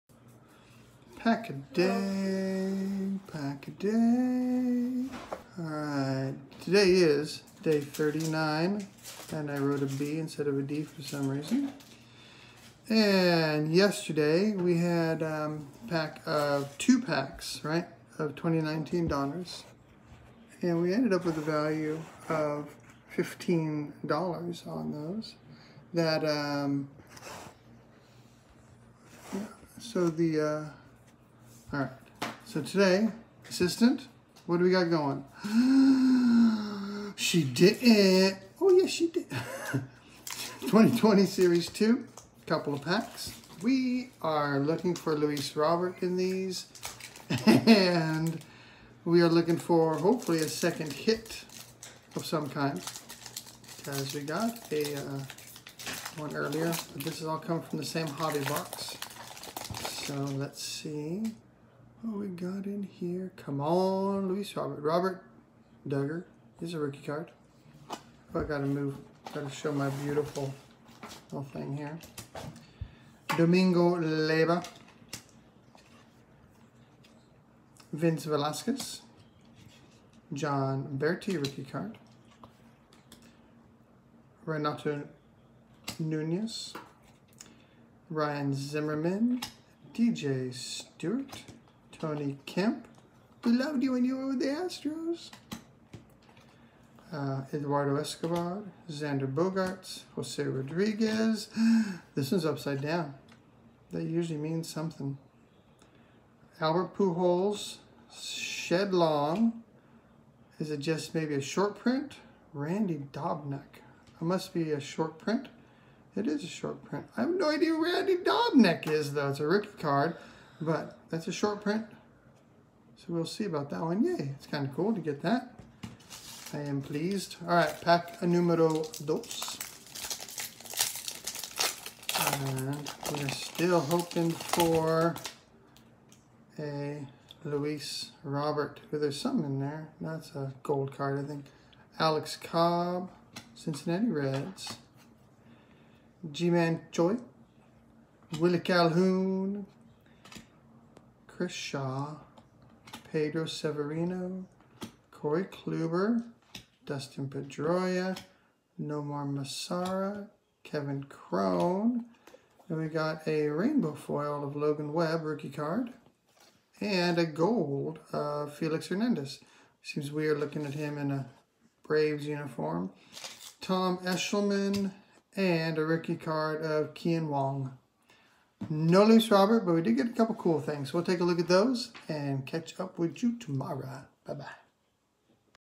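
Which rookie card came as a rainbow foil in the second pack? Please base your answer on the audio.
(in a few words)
Logan Webb.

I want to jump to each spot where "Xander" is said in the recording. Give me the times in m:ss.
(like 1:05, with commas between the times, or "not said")
1:38.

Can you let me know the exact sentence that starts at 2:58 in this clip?
No Luis Robert, but we did get a couple cool things.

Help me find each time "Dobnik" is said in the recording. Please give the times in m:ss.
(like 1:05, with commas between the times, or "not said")
1:53, 1:58.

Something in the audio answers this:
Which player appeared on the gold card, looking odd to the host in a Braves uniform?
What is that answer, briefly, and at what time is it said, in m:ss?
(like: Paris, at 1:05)
Felix Hernandez, at 2:48.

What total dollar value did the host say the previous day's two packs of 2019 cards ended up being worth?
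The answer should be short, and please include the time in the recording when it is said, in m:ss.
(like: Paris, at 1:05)
$15, at 0:23.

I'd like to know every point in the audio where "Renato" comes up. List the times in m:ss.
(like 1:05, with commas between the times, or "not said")
1:24.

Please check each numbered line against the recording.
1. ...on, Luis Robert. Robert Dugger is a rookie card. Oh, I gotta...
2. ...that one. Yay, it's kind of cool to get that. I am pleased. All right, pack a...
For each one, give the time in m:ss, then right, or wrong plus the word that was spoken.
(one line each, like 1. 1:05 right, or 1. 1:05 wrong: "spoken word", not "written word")
1. 1:03 right
2. 2:03 right.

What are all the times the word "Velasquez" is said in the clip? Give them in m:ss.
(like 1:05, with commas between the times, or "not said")
1:18.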